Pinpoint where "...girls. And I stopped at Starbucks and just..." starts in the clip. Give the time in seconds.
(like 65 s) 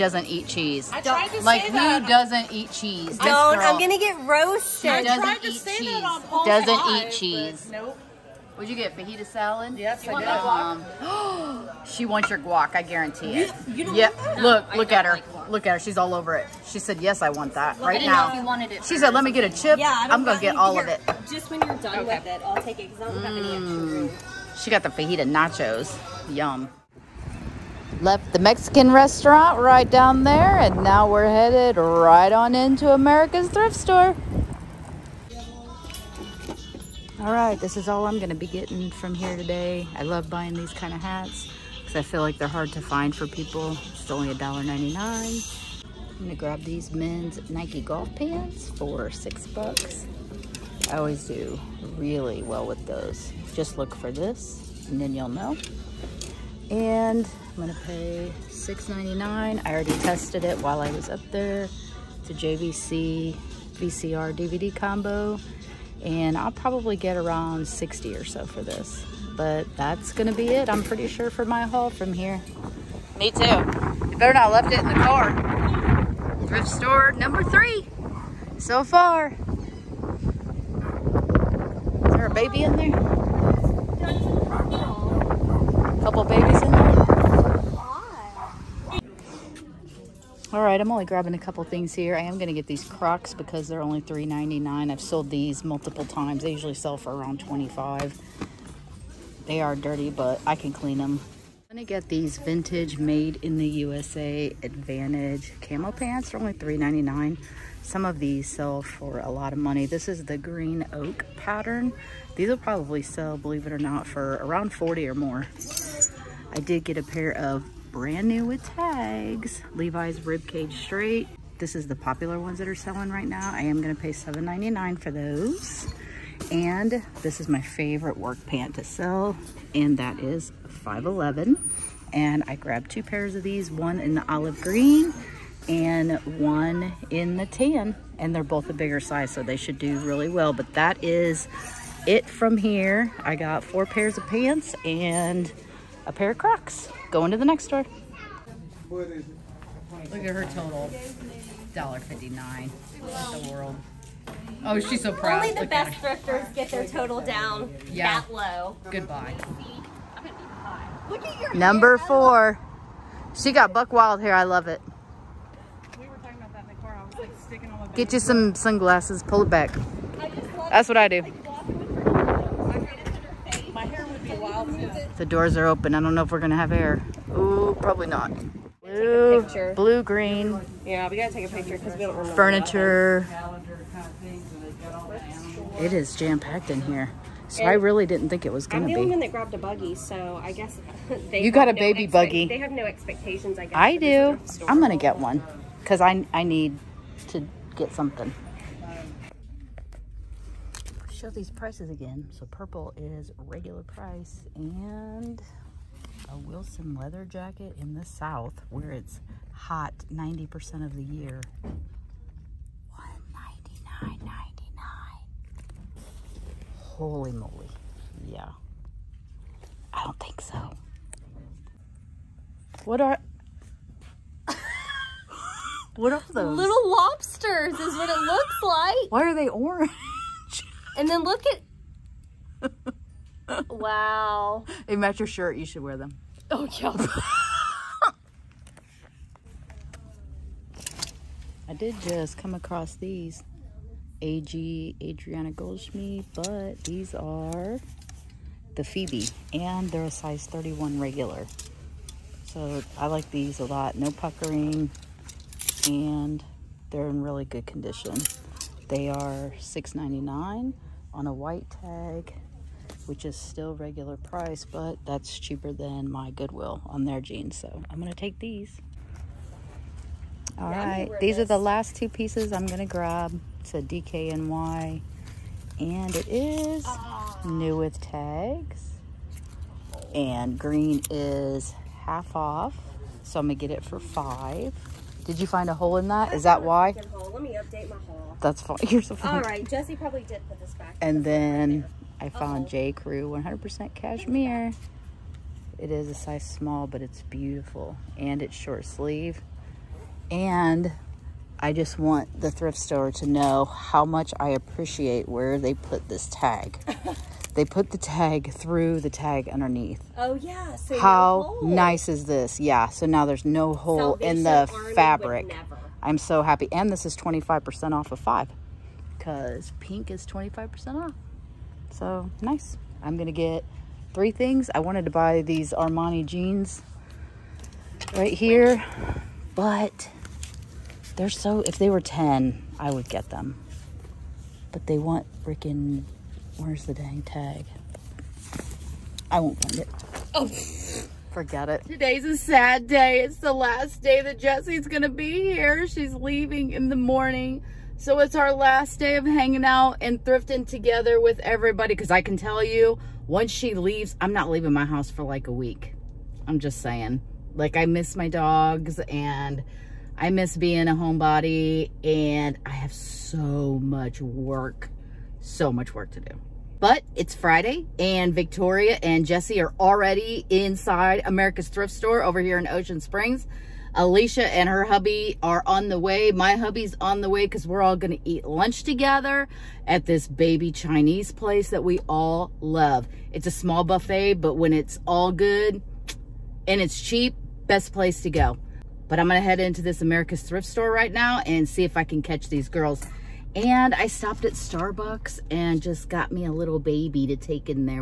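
392 s.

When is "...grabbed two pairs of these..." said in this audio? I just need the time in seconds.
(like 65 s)
132 s.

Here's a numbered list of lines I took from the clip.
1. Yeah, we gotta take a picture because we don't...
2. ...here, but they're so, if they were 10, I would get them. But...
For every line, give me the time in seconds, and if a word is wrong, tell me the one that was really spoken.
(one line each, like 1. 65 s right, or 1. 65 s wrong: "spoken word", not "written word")
1. 180 s right
2. 328 s right.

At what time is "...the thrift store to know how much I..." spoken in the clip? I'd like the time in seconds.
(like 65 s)
302 s.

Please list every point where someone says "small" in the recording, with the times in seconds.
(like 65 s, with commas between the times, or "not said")
296 s, 383 s.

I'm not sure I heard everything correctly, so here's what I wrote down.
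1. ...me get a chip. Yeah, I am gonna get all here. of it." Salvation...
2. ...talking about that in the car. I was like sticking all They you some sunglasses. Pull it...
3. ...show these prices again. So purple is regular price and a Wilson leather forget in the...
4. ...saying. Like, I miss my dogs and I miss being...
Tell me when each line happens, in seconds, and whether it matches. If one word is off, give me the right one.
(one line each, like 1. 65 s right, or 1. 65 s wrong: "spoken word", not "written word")
1. 19 s wrong: "Just", not "Salvation"
2. 166 s wrong: "Get", not "They"
3. 201 s wrong: "jacket", not "forget"
4. 356 s right.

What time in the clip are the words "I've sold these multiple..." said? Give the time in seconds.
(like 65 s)
94 s.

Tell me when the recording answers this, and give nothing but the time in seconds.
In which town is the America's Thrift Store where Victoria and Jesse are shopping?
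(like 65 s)
372 s.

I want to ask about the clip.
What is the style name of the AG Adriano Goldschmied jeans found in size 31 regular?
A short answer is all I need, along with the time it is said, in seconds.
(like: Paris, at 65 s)
Phoebe, at 248 s.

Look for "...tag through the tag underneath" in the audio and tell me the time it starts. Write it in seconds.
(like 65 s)
307 s.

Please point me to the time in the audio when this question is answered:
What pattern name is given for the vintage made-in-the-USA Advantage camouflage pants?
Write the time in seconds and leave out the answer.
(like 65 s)
110 s.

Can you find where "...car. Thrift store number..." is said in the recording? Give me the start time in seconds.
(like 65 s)
74 s.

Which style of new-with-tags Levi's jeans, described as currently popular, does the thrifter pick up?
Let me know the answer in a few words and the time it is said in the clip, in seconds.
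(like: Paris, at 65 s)
Ribcage Straight, at 120 s.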